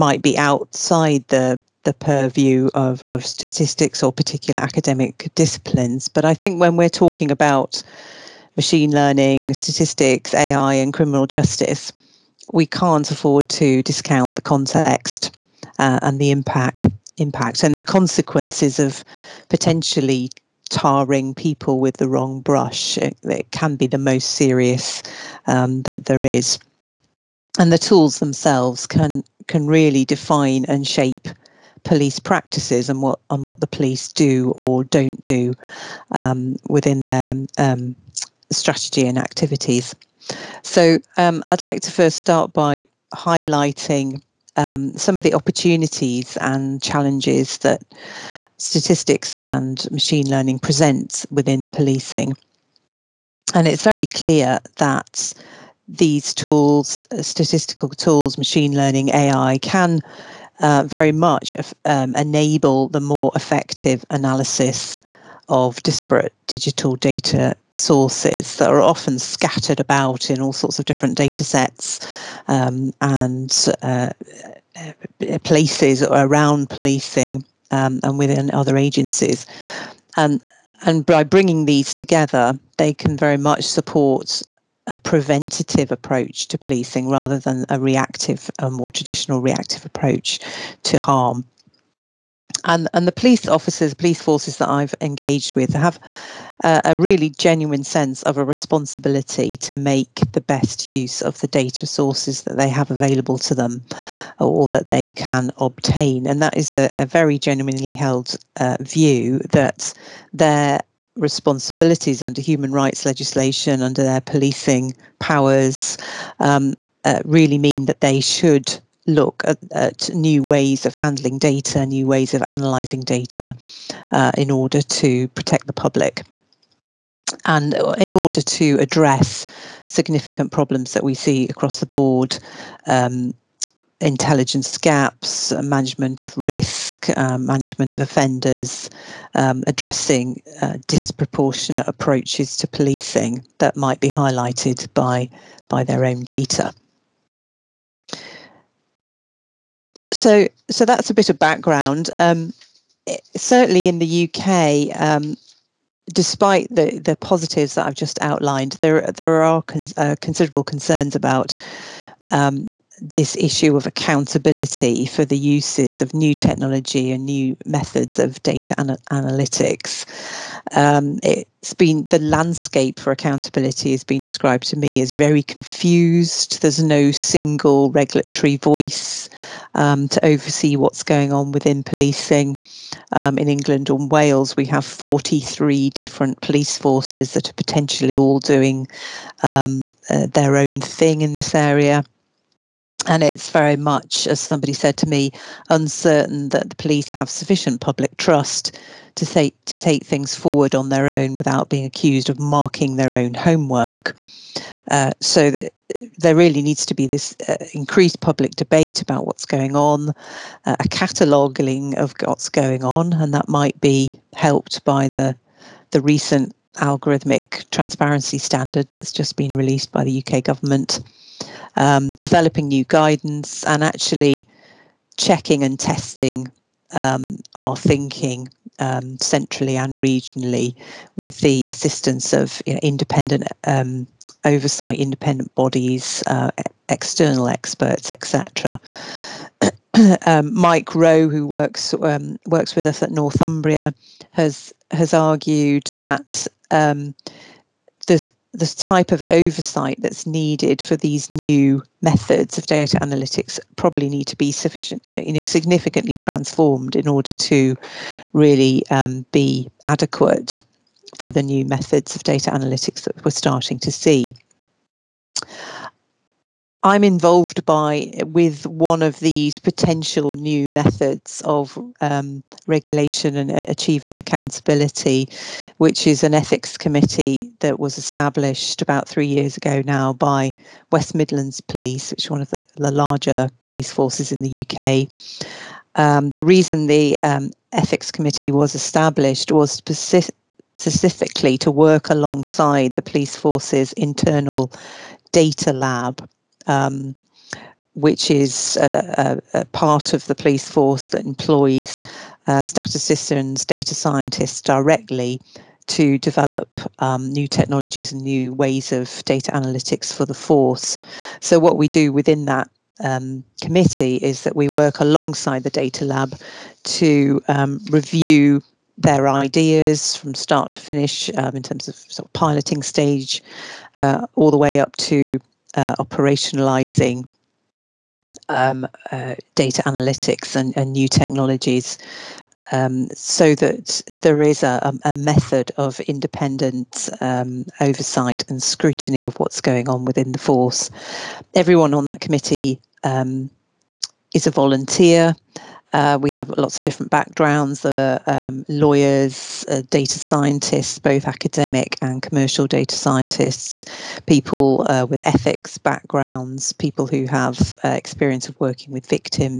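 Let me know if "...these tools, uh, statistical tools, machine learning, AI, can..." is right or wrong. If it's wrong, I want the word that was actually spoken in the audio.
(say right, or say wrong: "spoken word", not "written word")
right.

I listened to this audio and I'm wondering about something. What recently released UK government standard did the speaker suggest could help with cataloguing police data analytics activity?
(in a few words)
algorithmic transparency standard.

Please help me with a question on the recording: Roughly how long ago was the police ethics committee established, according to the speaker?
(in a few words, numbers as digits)
about 3 years.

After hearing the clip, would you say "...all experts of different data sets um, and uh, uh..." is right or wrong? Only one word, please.
wrong.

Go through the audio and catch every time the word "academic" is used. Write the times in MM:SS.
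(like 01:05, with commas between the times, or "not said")
00:04, 05:51.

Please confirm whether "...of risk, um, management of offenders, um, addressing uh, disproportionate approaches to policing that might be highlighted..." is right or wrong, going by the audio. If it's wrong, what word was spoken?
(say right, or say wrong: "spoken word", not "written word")
right.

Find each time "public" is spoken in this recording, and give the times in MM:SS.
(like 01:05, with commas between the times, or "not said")
02:05, 03:17, 03:28.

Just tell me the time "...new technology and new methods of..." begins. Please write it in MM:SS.
02:46.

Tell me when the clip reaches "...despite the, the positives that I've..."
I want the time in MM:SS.
02:36.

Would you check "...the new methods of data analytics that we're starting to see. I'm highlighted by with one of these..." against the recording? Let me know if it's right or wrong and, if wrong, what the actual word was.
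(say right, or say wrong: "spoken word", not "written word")
wrong: "involved", not "highlighted".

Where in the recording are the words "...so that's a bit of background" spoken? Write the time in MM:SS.
02:30.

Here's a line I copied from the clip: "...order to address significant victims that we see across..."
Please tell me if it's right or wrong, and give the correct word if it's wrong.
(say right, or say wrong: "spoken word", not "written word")
wrong: "problems", not "victims".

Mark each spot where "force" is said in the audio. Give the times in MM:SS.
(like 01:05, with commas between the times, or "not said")
01:34, 03:06, 04:43, 04:53, 05:00, 05:10, 05:40.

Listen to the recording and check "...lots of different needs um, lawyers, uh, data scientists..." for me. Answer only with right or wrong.
wrong.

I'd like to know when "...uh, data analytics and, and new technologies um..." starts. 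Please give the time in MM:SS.
05:29.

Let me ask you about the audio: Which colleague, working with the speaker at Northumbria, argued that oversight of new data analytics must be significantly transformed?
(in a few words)
Mike Rowe.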